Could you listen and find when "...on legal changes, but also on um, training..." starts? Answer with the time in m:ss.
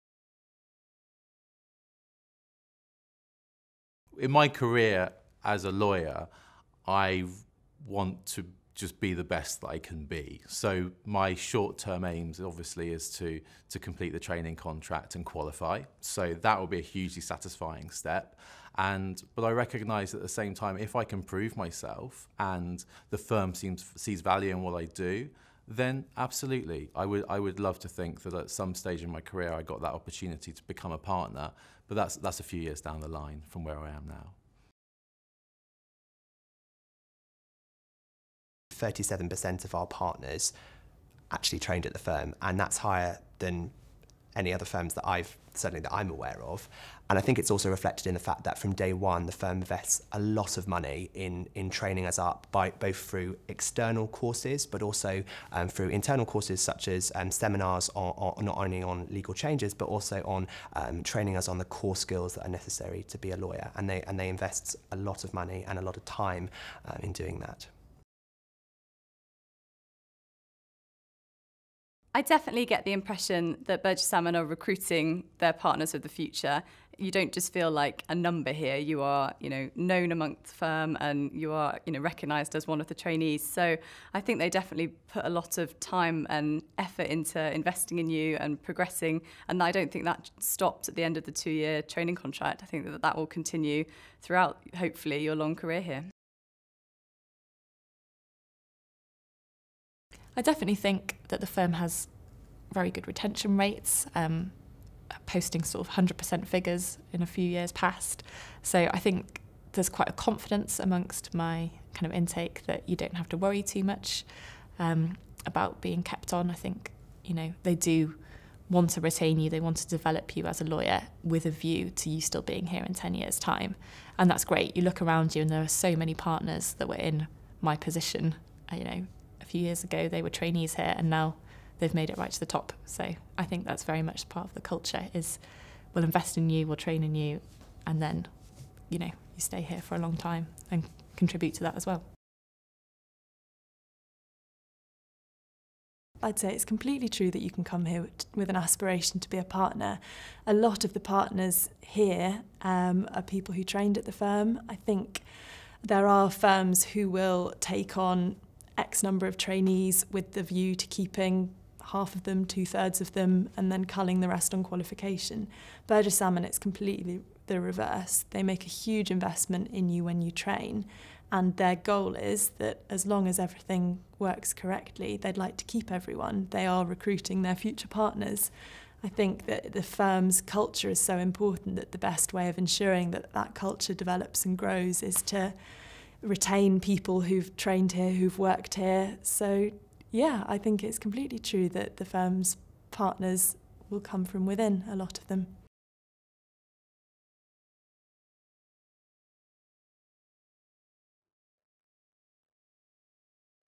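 0:58.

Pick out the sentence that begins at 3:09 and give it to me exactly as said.
So, yeah, I think it's completely true that the firm's partners will come from within, a lot of them.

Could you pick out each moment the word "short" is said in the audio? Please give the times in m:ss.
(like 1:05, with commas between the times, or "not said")
0:11.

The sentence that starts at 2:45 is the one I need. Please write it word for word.
Burges Salmon, it's completely the reverse.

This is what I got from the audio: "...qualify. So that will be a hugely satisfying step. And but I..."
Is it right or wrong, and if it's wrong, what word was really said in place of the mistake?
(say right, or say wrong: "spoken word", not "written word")
right.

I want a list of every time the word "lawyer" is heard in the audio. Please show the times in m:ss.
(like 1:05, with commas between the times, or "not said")
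0:05, 1:03, 2:00.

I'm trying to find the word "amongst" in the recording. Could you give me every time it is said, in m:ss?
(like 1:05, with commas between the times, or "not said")
1:20, 1:50.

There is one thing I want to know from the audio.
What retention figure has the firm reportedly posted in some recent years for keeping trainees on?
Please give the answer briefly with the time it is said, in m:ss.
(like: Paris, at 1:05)
100%, at 1:45.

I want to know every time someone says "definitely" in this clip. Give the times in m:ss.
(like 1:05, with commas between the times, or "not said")
1:12, 1:24, 1:40.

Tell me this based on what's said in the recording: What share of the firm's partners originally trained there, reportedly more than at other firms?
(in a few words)
37%.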